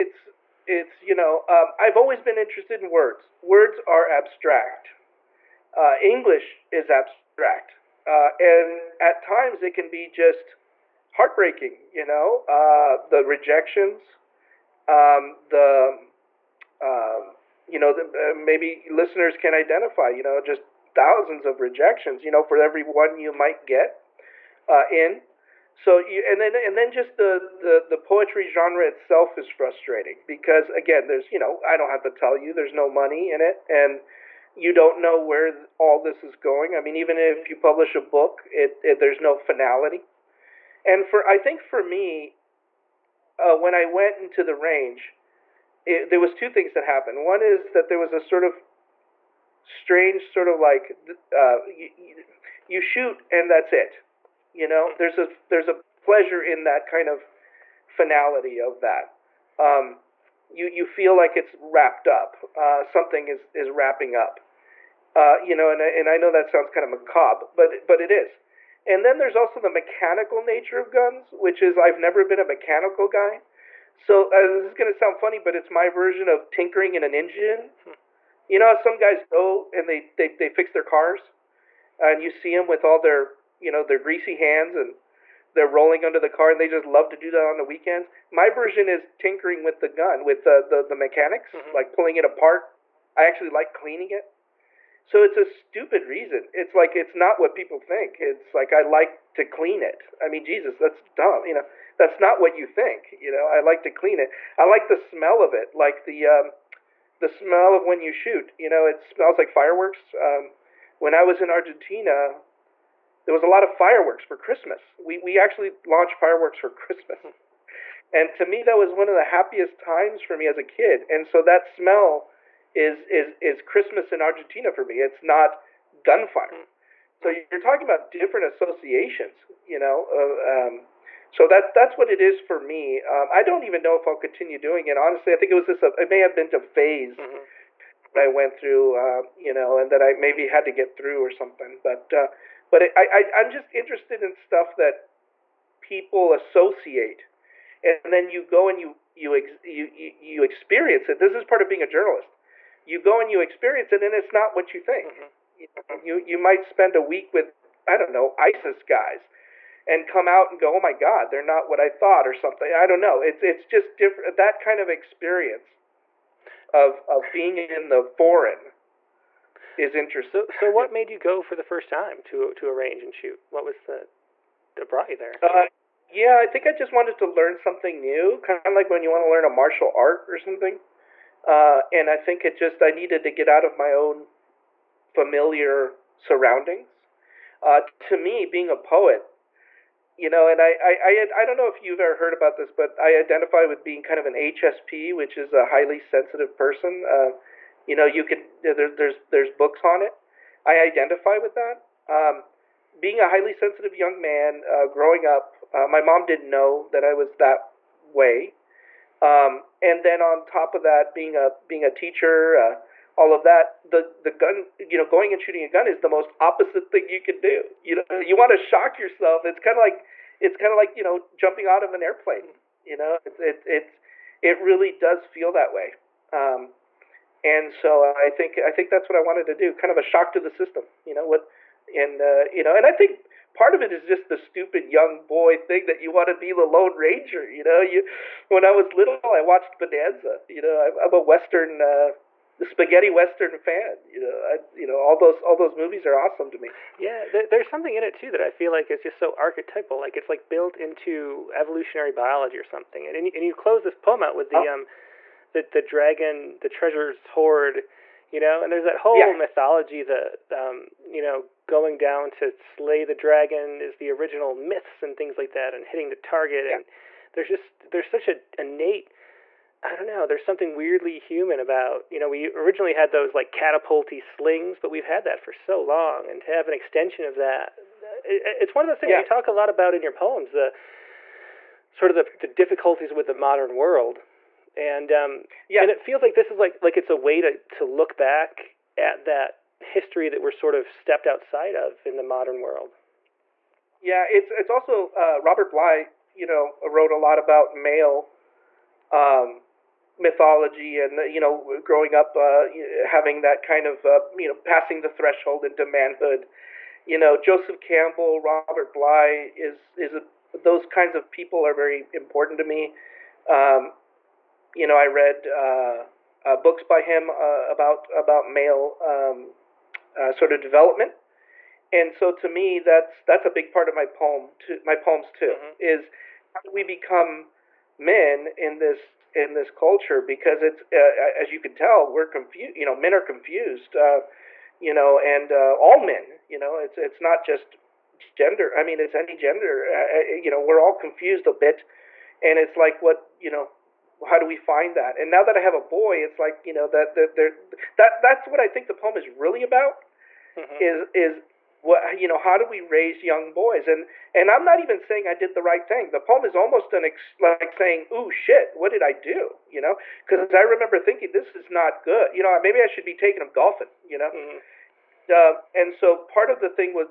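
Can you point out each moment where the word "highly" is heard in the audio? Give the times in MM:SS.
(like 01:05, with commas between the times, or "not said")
03:15, 03:23.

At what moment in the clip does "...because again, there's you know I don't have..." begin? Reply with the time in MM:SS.
00:30.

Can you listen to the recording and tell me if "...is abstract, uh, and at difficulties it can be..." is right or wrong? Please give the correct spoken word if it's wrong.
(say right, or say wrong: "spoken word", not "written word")
wrong: "times", not "difficulties".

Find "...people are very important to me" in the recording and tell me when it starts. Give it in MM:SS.
05:11.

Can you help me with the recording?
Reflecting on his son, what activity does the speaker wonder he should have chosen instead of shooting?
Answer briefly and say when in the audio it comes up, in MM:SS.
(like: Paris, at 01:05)
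Golfing, at 06:03.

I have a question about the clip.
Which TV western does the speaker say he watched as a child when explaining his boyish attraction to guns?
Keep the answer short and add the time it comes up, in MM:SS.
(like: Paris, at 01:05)
Bonanza, at 03:59.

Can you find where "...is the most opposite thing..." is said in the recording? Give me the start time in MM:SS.
03:35.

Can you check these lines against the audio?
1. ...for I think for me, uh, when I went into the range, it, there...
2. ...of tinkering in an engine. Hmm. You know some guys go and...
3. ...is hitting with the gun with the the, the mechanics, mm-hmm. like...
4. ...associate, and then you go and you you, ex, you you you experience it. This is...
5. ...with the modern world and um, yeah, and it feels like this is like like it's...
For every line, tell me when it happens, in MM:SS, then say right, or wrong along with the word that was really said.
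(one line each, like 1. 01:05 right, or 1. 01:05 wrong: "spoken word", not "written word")
1. 00:41 right
2. 01:16 right
3. 01:28 wrong: "tinkering", not "hitting"
4. 02:26 right
5. 04:43 right.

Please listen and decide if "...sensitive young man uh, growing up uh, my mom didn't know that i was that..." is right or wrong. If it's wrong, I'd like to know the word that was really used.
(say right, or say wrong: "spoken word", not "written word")
right.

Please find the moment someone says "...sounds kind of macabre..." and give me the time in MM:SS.
01:06.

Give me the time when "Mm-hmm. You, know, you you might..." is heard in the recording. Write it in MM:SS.
02:35.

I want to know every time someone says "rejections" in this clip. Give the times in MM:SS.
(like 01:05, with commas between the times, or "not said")
00:13, 00:21.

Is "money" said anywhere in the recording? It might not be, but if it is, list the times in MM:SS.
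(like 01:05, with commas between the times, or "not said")
00:32.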